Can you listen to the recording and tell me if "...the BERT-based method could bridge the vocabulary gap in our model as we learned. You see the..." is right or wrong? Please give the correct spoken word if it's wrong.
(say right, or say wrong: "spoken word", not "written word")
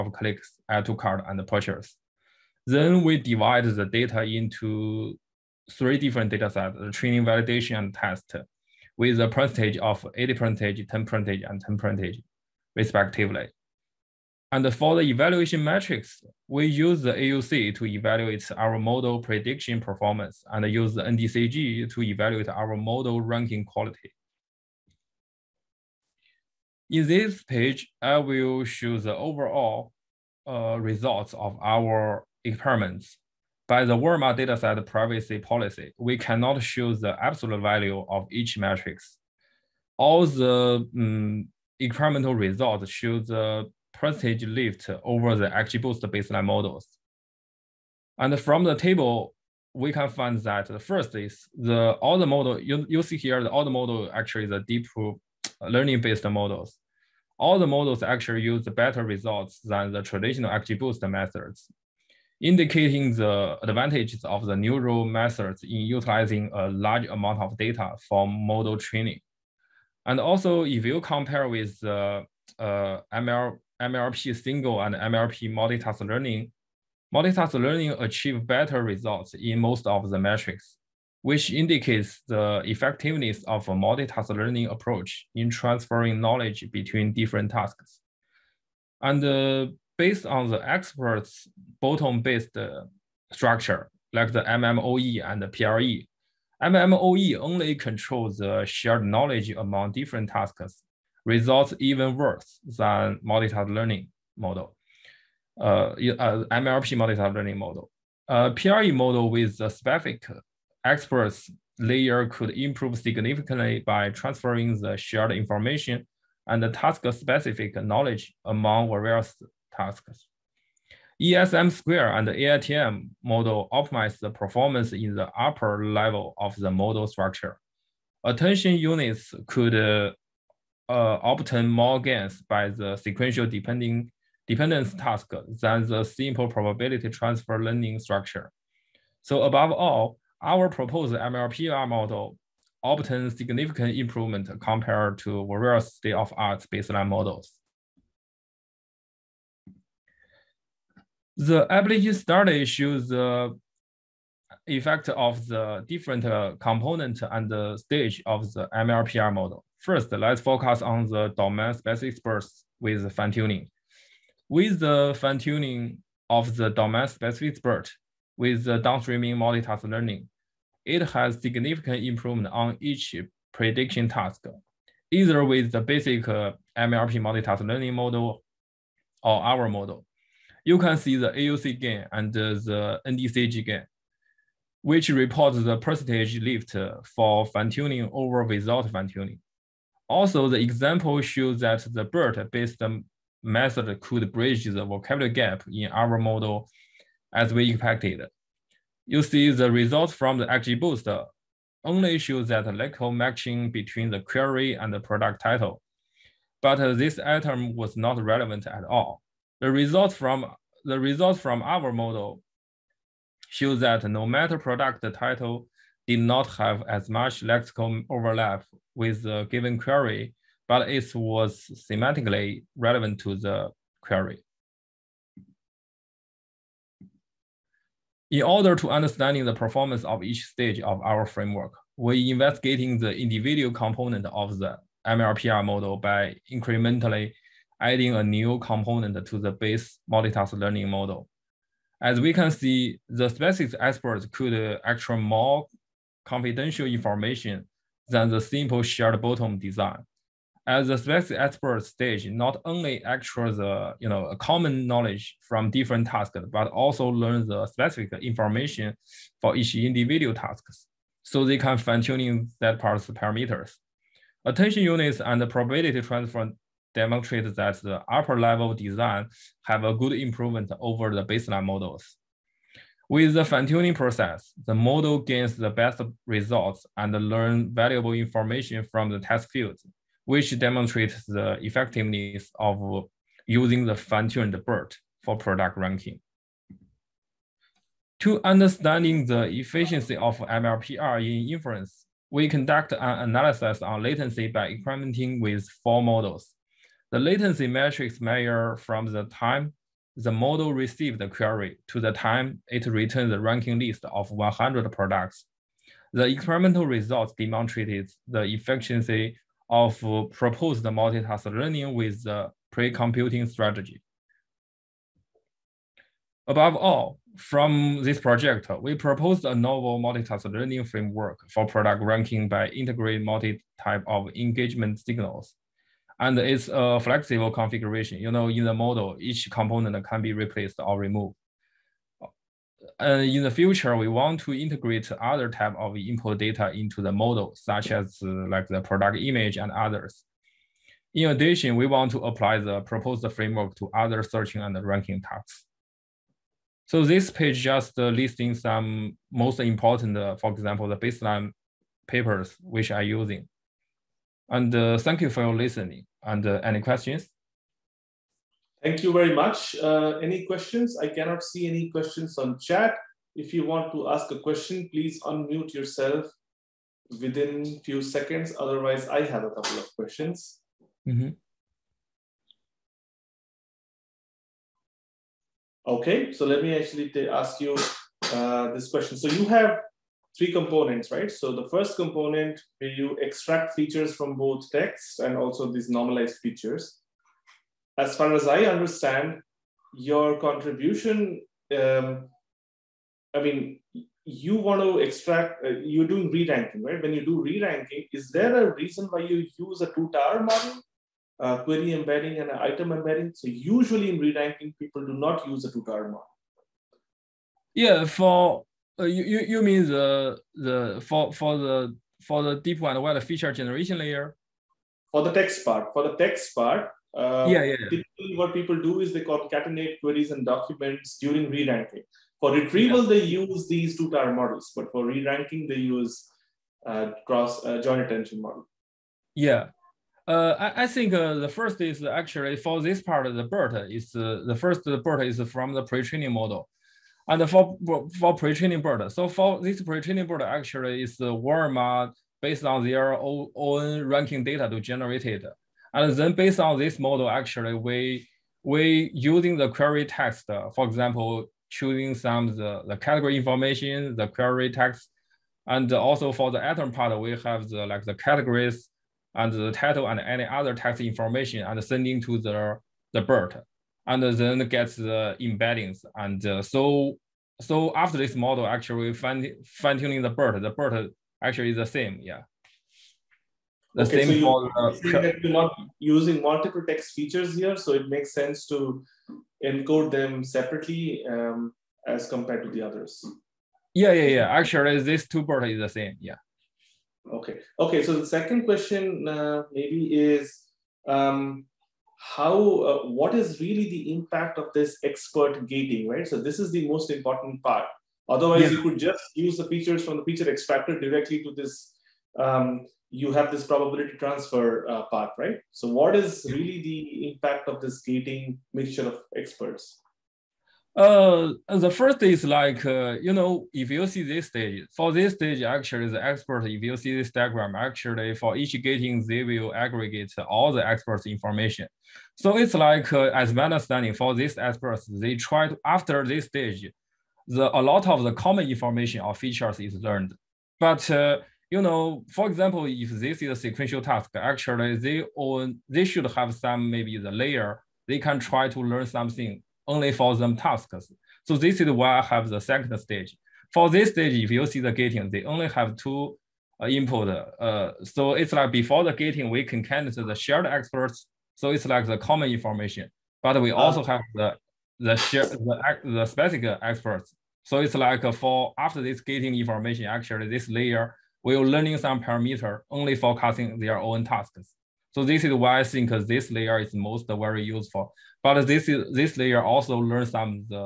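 wrong: "expected", not "learned".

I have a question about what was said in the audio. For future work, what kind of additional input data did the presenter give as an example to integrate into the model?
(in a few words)
product image.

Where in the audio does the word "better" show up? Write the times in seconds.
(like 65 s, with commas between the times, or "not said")
58 s, 78 s.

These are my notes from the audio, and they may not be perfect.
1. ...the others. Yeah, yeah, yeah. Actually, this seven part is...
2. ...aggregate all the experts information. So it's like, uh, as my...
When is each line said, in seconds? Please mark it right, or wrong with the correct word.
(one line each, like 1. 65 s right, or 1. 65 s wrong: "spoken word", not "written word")
1. 482 s wrong: "two", not "seven"
2. 519 s right.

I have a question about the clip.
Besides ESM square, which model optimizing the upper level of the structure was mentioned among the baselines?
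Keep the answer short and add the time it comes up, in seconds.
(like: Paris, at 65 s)
AITM, at 122 s.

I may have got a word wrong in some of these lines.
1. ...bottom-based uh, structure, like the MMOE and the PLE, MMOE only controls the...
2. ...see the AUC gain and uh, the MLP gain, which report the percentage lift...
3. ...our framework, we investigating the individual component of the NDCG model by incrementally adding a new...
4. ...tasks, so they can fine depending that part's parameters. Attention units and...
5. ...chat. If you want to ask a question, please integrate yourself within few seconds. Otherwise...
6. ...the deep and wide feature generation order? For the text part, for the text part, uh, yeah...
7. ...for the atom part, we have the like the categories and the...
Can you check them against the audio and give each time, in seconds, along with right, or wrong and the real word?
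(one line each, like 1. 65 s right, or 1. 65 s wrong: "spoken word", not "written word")
1. 91 s right
2. 180 s wrong: "NDCG", not "MLP"
3. 231 s wrong: "MLPR", not "NDCG"
4. 260 s wrong: "tuning", not "depending"
5. 362 s wrong: "unmute", not "integrate"
6. 412 s wrong: "layer", not "order"
7. 456 s right.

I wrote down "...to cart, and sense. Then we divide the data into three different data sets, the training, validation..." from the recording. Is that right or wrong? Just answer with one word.
wrong.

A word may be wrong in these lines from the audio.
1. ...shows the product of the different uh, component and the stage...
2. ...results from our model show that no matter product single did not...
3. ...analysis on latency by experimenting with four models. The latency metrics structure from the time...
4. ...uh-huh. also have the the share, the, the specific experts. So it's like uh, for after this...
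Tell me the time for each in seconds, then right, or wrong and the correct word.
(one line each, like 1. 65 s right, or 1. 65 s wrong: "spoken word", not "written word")
1. 152 s wrong: "effect", not "product"
2. 210 s wrong: "title", not "single"
3. 293 s wrong: "measure", not "structure"
4. 553 s right.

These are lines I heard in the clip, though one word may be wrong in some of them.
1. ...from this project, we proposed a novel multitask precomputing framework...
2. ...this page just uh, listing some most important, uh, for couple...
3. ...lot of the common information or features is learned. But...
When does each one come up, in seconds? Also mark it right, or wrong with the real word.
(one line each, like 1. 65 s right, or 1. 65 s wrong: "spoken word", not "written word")
1. 317 s wrong: "learning", not "precomputing"
2. 347 s wrong: "example", not "couple"
3. 527 s right.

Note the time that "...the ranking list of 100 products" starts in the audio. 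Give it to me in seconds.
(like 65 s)
303 s.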